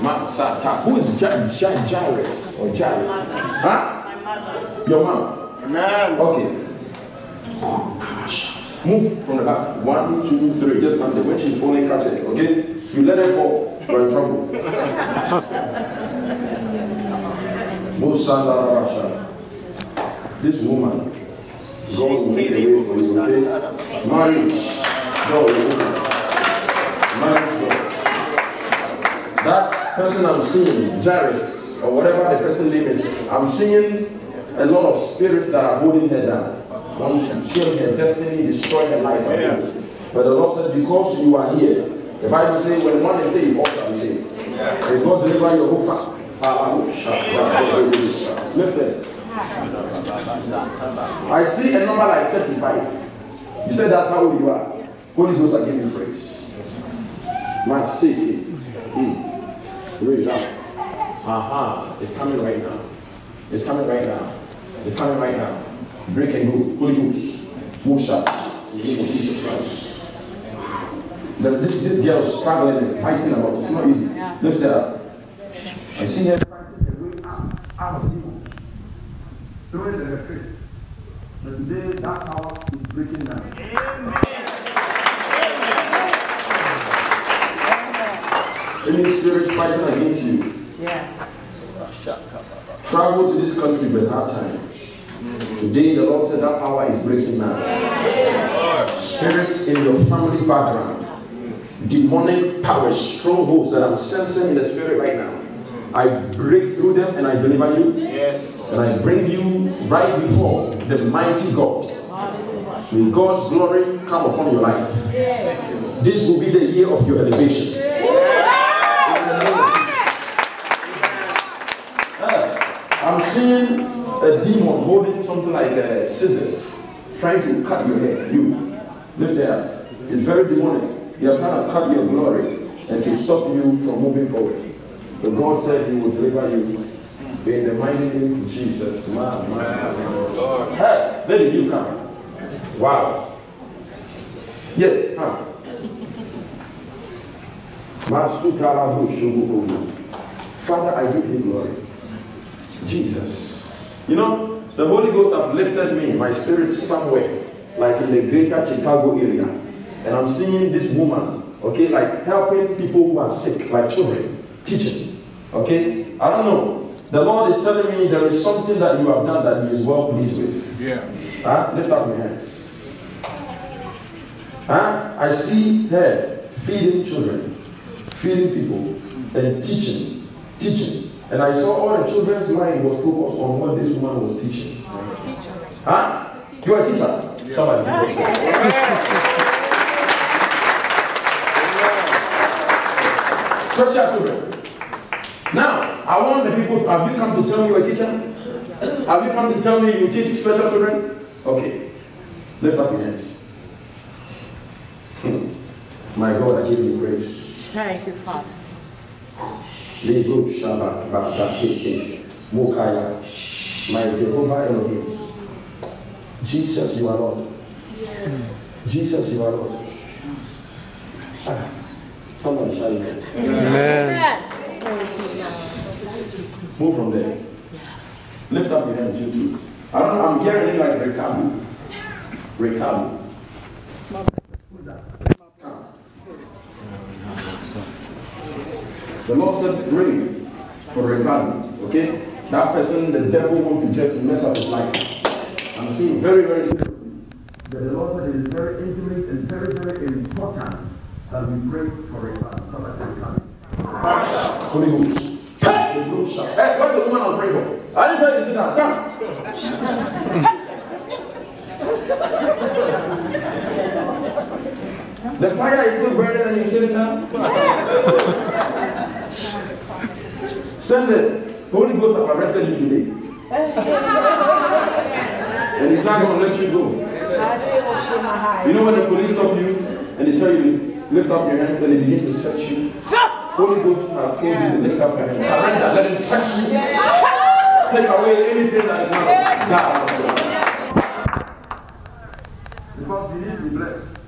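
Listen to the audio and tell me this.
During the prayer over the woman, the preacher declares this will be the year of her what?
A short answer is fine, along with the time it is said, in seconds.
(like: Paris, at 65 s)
elevation, at 117 s.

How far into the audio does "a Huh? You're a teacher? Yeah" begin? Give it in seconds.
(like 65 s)
184 s.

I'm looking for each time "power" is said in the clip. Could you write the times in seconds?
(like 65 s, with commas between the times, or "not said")
82 s, 96 s, 102 s.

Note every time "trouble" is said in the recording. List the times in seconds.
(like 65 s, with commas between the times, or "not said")
14 s.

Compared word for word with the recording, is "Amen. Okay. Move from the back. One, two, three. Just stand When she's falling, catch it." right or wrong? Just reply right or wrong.
right.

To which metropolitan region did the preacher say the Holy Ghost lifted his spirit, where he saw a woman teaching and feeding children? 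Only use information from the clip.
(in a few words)
greater Chicago area.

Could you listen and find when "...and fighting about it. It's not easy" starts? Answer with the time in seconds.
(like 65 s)
72 s.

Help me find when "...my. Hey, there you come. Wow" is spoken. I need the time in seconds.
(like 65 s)
139 s.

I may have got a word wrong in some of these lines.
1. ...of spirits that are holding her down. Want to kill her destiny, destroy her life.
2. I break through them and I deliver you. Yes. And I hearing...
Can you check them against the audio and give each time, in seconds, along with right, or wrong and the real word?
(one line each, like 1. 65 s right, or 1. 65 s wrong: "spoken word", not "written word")
1. 34 s right
2. 105 s wrong: "bring", not "hearing".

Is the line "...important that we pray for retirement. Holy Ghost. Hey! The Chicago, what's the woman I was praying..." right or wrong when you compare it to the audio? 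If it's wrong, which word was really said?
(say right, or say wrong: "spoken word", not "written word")
wrong: "Hey", not "Chicago".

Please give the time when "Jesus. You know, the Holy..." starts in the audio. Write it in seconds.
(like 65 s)
152 s.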